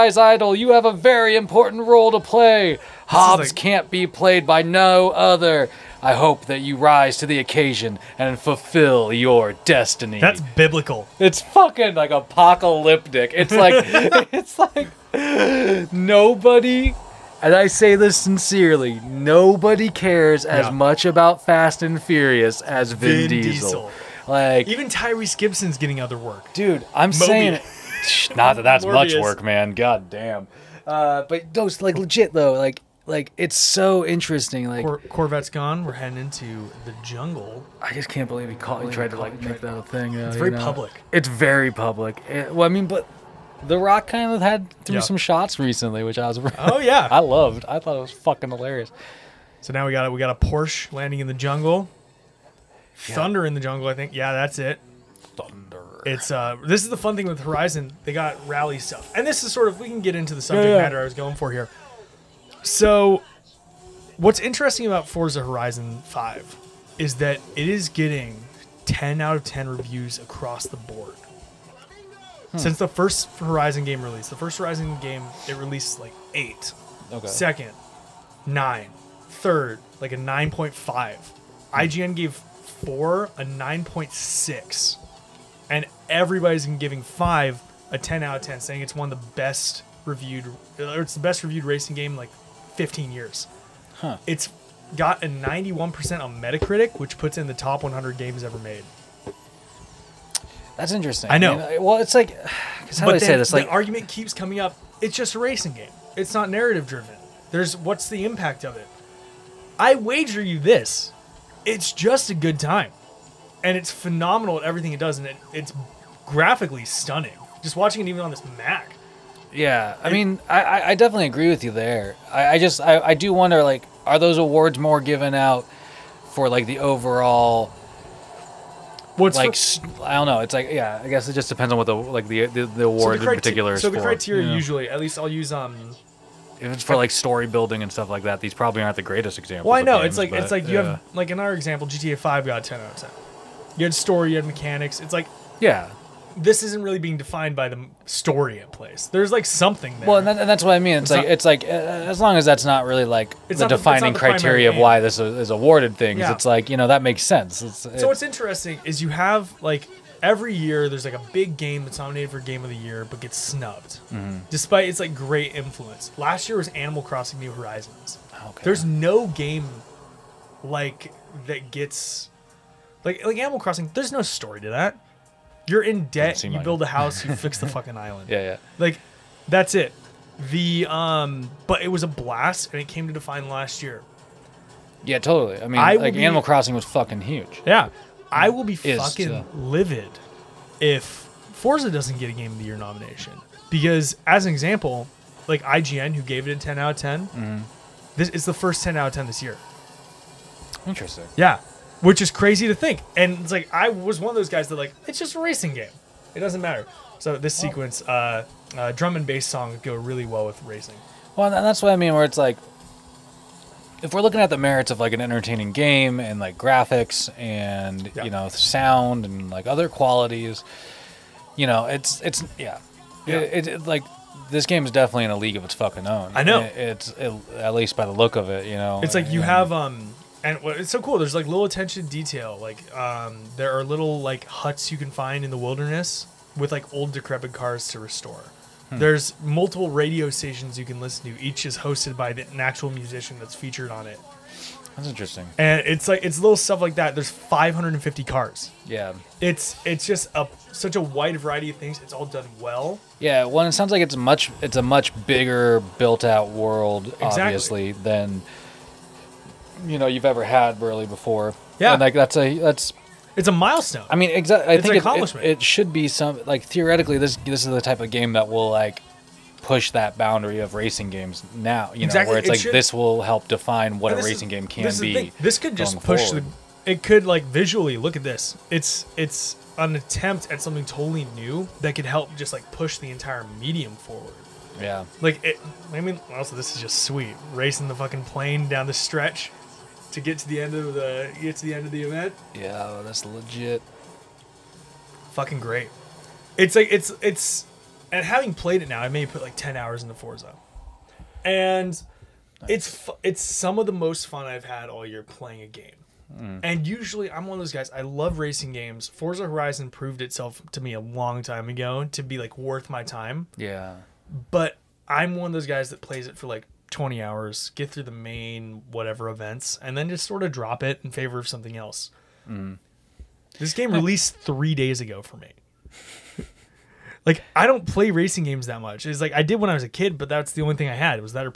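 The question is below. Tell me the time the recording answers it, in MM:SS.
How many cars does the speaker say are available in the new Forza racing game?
04:07.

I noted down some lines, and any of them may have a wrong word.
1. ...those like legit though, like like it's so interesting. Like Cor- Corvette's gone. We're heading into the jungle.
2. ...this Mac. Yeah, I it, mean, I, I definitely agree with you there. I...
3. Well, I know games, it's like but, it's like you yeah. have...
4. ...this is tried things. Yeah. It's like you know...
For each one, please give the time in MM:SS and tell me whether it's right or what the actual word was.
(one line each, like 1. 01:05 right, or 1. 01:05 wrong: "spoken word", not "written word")
1. 00:31 right
2. 01:58 right
3. 02:19 right
4. 02:34 wrong: "awarded", not "tried".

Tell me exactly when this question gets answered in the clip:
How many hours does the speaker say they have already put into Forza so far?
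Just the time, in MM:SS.
04:59.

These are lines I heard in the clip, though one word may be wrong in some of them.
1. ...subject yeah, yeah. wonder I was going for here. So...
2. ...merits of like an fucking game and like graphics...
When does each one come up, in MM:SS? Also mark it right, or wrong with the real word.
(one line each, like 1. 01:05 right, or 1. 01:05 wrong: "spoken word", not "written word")
1. 01:00 wrong: "matter", not "wonder"
2. 03:34 wrong: "entertaining", not "fucking".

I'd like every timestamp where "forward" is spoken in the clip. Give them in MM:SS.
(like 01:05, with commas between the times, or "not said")
04:36, 04:43.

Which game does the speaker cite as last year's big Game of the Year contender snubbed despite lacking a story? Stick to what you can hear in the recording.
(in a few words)
Animal Crossing New Horizons.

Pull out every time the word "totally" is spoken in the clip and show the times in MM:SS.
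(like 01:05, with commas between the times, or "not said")
03:05, 04:40.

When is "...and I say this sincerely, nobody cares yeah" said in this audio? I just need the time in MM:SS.
00:17.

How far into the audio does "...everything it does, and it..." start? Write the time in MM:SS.
01:54.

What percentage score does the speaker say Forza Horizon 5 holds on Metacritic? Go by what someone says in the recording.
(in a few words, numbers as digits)
91%.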